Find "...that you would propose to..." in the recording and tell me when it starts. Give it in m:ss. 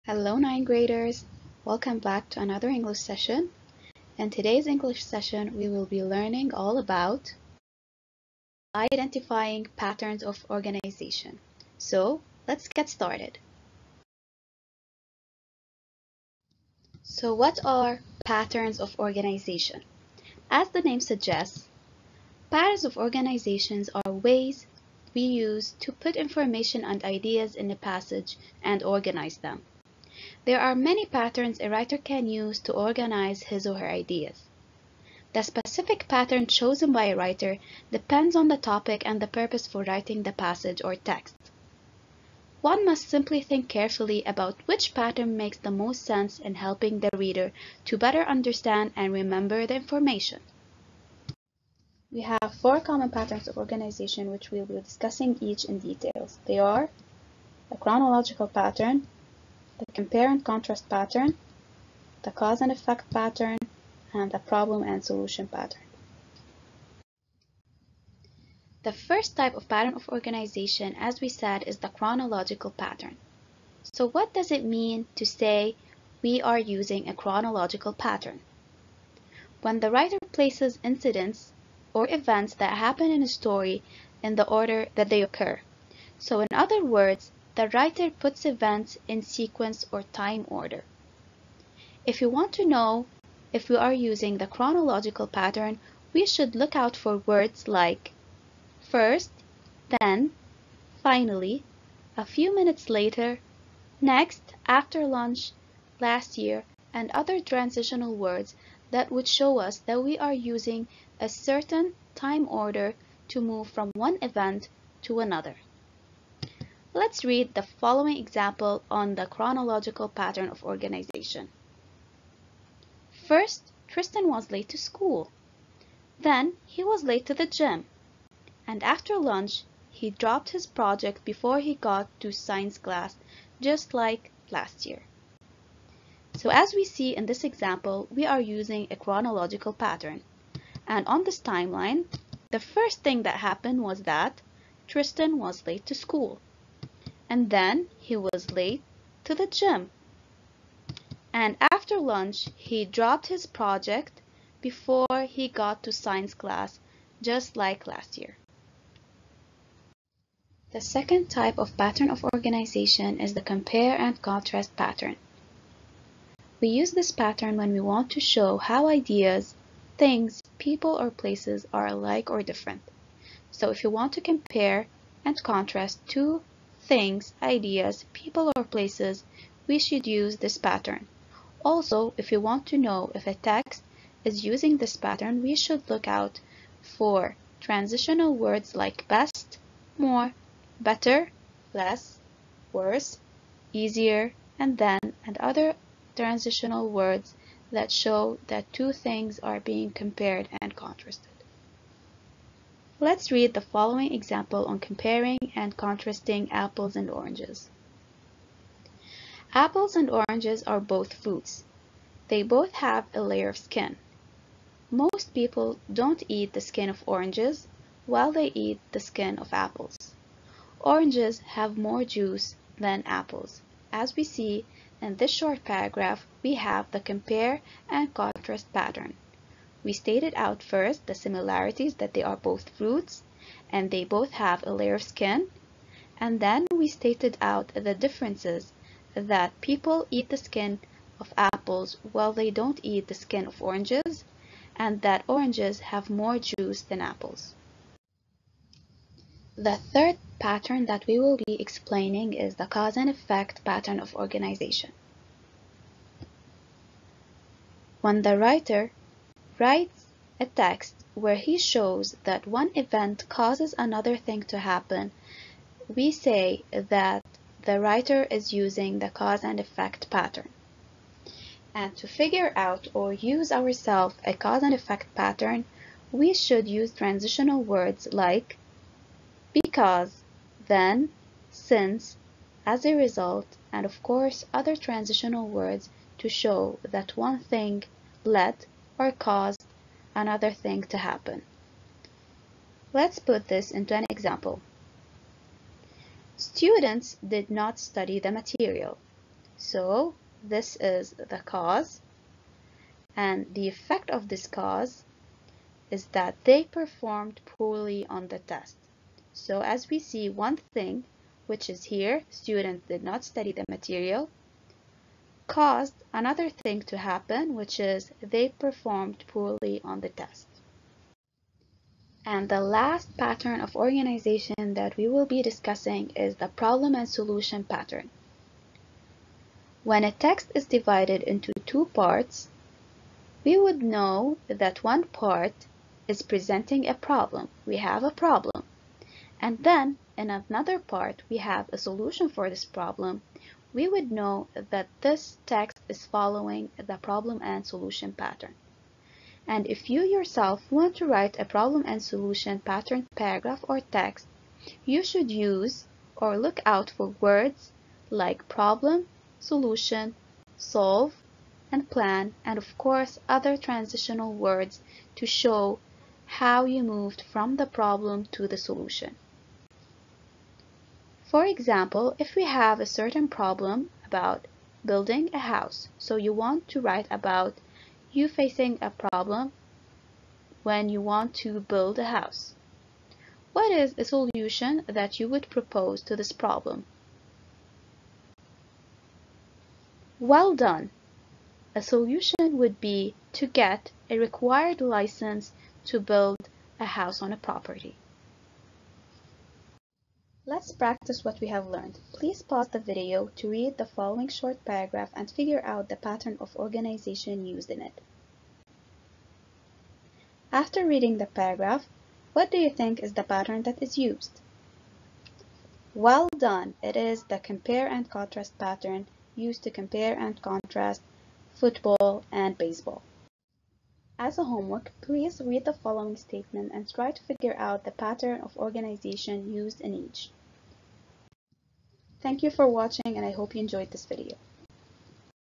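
6:24.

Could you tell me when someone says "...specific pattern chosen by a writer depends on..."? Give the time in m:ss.
0:35.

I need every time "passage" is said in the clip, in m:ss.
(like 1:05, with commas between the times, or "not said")
0:27, 0:40.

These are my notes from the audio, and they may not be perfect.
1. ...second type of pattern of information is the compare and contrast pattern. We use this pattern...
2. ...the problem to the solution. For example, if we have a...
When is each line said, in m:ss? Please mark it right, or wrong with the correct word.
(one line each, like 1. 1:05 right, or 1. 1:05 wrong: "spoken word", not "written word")
1. 2:40 wrong: "organization", not "information"
2. 6:07 right.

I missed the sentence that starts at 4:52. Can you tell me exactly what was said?
Let's put this into an example.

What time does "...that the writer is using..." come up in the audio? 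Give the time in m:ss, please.
4:26.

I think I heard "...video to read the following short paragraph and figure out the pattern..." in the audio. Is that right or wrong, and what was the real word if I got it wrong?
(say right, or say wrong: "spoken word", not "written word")
right.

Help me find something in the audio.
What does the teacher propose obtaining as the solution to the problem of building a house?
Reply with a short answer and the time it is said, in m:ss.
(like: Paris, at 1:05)
a required license, at 6:34.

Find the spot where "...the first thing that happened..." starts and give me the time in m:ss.
2:22.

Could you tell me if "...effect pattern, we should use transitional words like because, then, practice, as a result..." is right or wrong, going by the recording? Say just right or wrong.
wrong.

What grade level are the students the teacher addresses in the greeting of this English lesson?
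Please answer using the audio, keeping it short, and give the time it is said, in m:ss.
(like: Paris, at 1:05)
ninth graders, at 0:00.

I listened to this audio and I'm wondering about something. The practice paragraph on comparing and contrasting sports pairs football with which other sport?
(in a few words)
baseball.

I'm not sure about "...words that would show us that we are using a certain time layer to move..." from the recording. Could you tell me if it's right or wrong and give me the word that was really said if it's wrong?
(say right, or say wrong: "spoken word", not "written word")
wrong: "order", not "layer".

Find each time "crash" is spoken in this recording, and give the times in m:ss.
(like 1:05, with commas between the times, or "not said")
not said.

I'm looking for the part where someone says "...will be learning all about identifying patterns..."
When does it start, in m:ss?
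0:05.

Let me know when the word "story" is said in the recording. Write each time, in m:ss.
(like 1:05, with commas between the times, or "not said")
1:23.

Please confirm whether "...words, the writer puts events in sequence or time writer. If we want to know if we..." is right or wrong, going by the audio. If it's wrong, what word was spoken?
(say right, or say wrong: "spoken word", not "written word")
wrong: "order", not "writer".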